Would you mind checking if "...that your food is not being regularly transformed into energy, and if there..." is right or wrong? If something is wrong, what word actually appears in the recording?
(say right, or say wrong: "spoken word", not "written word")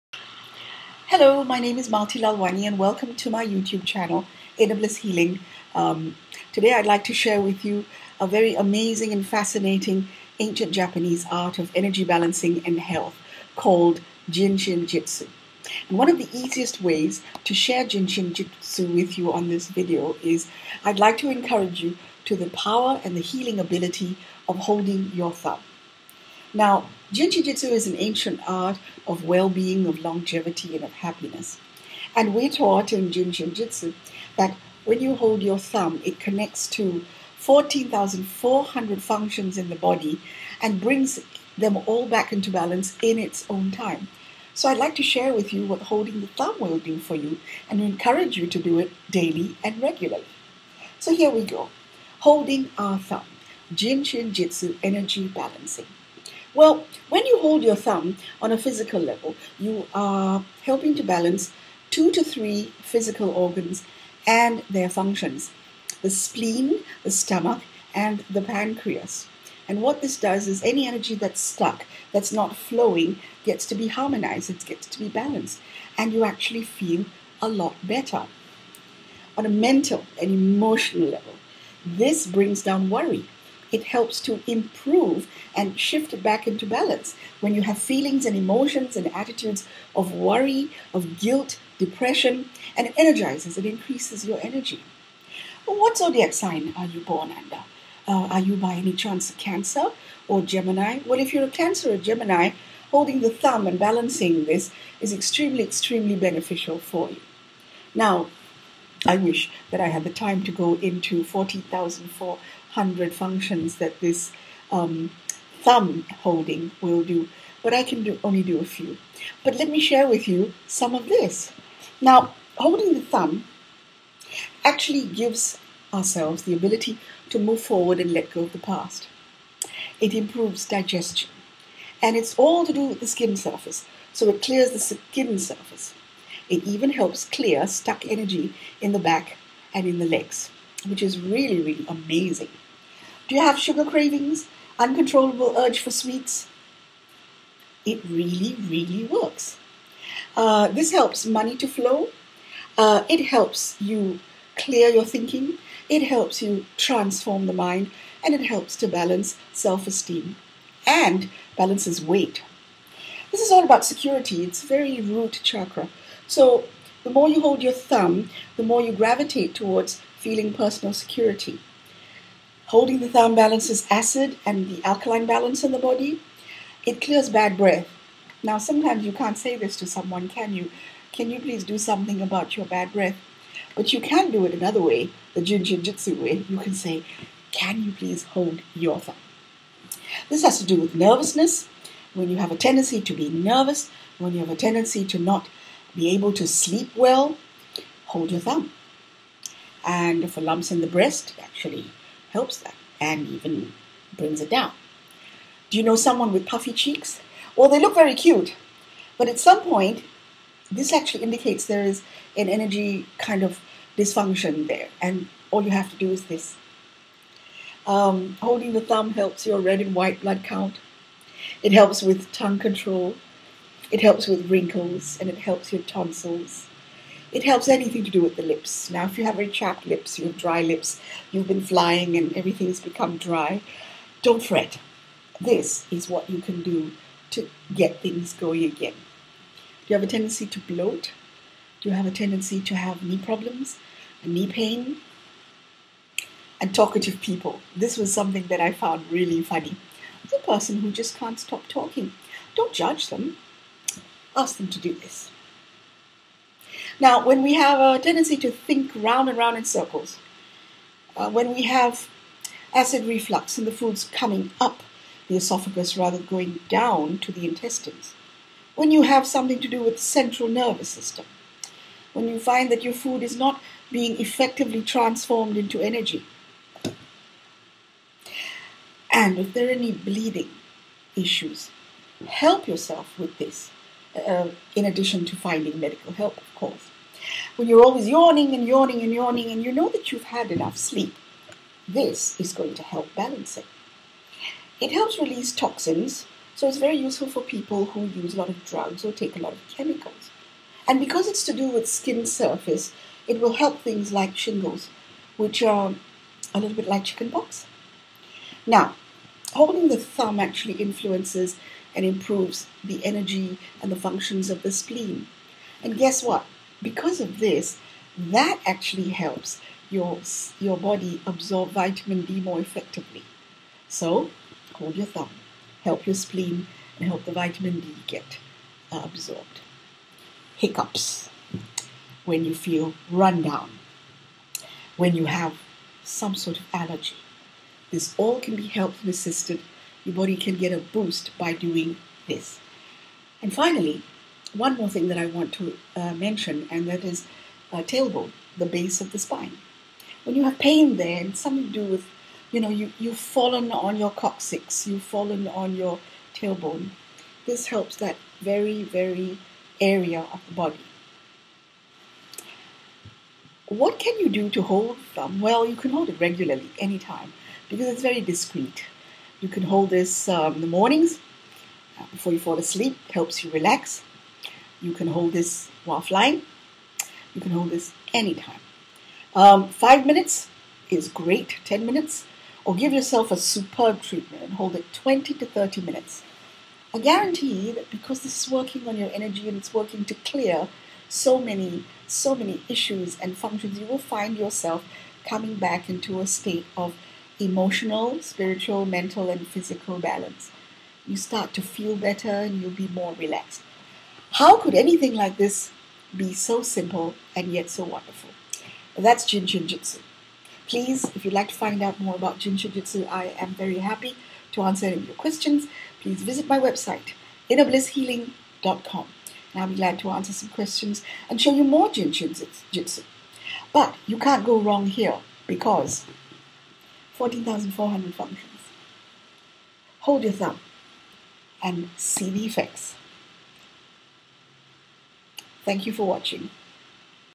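wrong: "effectively", not "regularly".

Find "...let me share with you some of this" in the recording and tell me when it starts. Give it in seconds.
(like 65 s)
119 s.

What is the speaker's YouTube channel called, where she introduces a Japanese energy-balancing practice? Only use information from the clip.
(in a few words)
AWS Healing.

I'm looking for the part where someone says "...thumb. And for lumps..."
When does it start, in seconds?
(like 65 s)
198 s.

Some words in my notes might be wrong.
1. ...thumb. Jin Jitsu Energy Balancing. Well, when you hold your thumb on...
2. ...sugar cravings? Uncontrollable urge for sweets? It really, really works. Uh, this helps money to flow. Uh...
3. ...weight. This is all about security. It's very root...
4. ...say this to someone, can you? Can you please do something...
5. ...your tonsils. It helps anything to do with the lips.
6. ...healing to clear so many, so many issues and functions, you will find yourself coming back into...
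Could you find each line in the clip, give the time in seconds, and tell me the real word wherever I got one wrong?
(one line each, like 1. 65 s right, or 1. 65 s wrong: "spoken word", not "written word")
1. 52 s right
2. 143 s right
3. 162 s right
4. 179 s right
5. 225 s right
6. 389 s wrong: "working", not "healing".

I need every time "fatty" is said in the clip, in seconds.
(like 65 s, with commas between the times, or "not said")
not said.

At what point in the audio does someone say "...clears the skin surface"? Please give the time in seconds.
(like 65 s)
134 s.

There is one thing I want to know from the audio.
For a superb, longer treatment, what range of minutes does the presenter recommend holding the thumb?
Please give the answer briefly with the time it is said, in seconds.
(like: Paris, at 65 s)
20 to 30 minutes, at 384 s.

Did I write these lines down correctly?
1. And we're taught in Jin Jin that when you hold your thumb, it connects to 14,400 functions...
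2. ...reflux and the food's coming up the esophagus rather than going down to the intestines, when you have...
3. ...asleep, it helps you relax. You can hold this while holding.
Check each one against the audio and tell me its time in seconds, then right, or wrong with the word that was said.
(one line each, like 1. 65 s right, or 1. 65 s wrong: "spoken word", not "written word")
1. 32 s wrong: "Jitsu", not "Jin"
2. 263 s right
3. 372 s wrong: "flying", not "holding".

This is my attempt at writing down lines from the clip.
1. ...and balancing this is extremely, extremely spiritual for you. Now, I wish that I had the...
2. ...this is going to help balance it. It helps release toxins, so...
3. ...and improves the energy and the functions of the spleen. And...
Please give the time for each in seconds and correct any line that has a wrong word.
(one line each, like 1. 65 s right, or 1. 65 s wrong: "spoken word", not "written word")
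1. 103 s wrong: "beneficial", not "spiritual"
2. 291 s right
3. 311 s right.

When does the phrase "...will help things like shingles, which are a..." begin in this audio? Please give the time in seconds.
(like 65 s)
303 s.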